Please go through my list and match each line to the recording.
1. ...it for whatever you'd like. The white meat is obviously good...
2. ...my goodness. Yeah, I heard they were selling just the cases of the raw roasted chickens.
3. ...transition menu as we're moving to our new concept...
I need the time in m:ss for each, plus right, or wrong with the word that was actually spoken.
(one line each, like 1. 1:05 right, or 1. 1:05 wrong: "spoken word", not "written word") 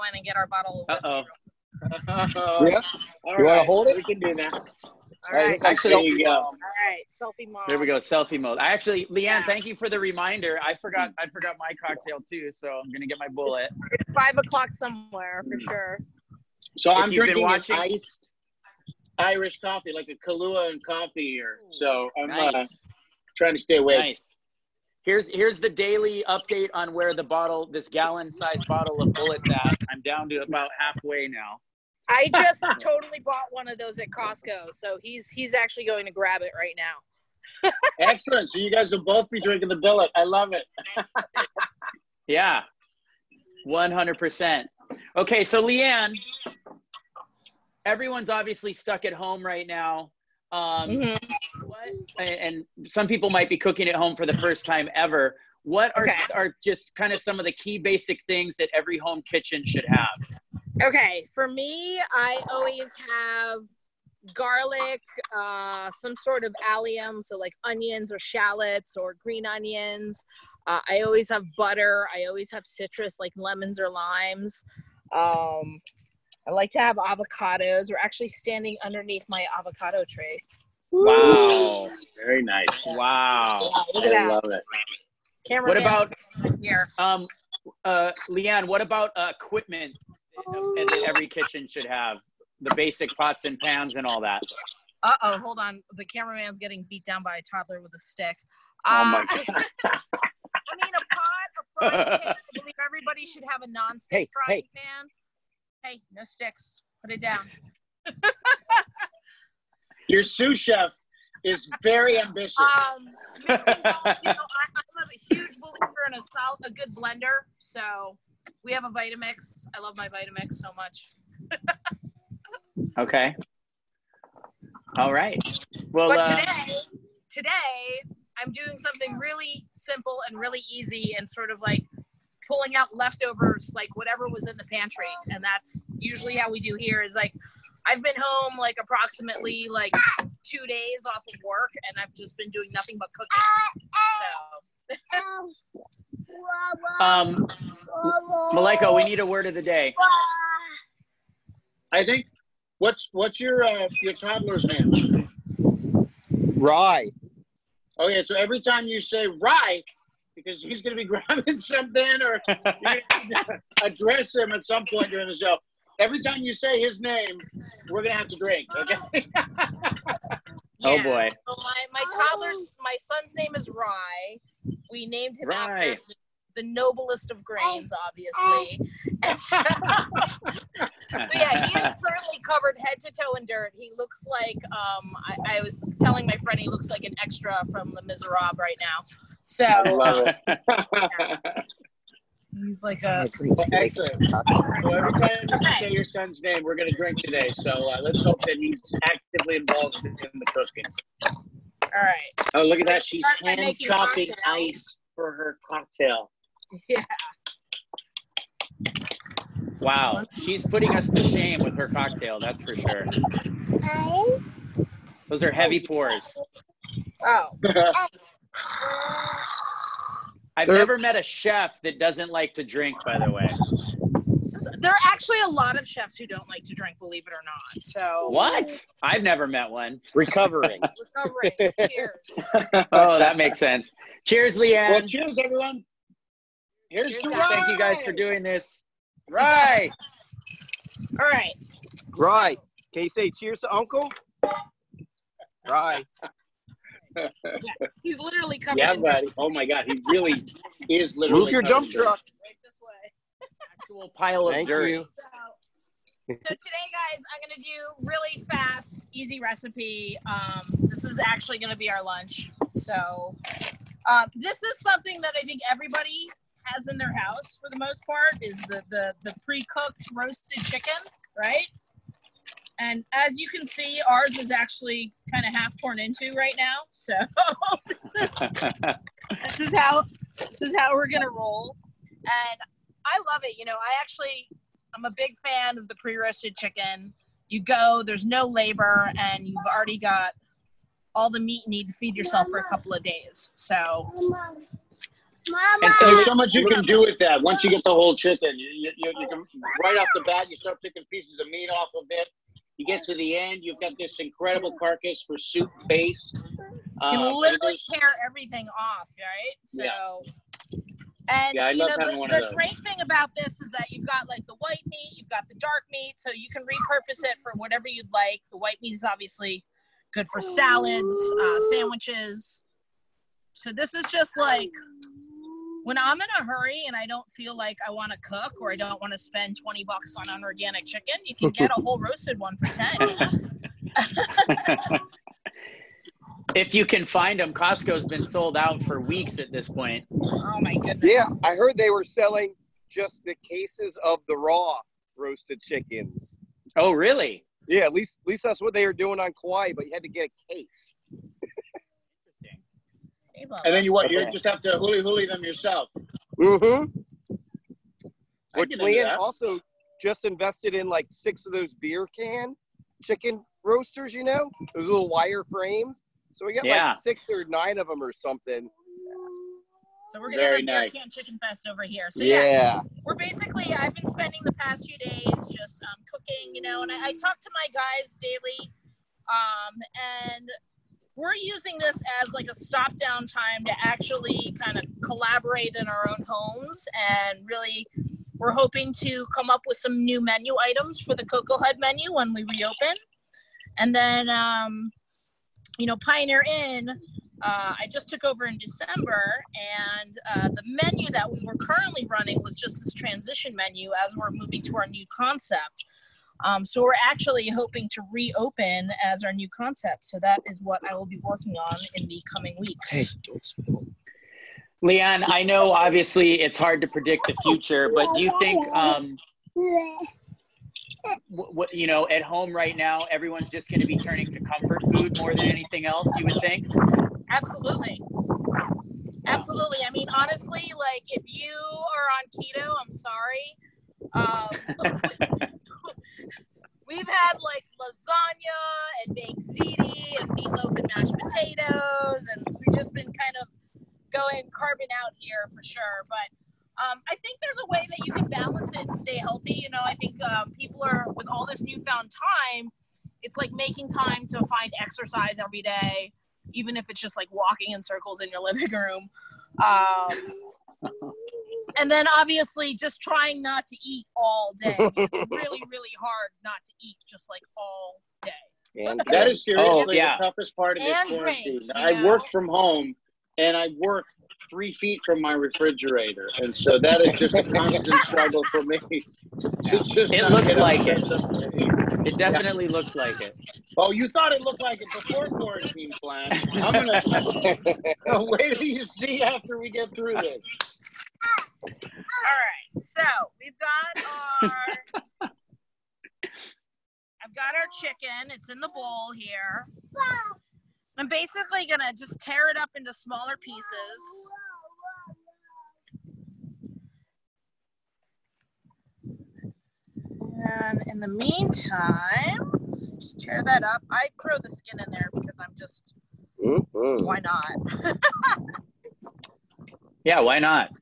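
1. 5:17 right
2. 5:40 right
3. 6:42 right.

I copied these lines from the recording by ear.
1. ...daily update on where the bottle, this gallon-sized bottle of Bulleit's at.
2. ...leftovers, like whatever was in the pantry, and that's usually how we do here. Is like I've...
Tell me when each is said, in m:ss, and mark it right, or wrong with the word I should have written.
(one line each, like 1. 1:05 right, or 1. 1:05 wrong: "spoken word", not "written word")
1. 0:25 right
2. 2:12 right.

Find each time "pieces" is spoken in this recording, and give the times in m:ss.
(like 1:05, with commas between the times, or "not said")
5:01, 8:23.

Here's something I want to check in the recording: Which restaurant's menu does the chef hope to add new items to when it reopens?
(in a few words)
Koko Head.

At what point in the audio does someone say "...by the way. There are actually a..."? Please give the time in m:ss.
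3:43.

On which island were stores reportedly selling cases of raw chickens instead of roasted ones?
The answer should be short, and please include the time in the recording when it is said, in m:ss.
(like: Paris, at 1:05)
Kauai, at 5:49.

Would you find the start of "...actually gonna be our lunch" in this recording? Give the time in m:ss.
4:21.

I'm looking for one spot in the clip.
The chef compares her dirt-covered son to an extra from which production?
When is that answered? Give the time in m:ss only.
3:07.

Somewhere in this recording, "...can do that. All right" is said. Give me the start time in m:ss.
0:04.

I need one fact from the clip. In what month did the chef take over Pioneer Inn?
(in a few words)
December.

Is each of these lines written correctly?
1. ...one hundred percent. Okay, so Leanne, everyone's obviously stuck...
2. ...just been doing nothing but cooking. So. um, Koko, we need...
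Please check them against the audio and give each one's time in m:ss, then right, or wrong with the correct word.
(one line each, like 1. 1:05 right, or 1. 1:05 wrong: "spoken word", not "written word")
1. 0:43 right
2. 2:22 wrong: "Maleko", not "Koko".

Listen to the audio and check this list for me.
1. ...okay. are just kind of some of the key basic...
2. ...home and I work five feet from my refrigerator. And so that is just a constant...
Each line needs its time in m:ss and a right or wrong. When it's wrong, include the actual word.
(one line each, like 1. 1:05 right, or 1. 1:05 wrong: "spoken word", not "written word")
1. 0:56 right
2. 7:52 wrong: "three", not "five".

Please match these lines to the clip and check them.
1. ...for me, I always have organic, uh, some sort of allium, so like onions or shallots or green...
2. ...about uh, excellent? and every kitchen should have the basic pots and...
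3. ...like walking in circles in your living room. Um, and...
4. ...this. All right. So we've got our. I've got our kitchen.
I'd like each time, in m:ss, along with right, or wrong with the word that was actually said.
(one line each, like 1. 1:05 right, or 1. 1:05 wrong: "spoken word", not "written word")
1. 1:01 wrong: "garlic", not "organic"
2. 1:28 wrong: "equipment", not "excellent"
3. 7:37 right
4. 8:10 wrong: "chicken", not "kitchen".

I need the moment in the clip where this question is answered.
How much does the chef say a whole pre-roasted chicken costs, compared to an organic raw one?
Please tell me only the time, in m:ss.
5:32.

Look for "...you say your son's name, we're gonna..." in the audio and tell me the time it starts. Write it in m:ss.
3:15.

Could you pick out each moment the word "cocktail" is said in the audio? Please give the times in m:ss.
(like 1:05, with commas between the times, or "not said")
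0:11, 3:25, 3:31.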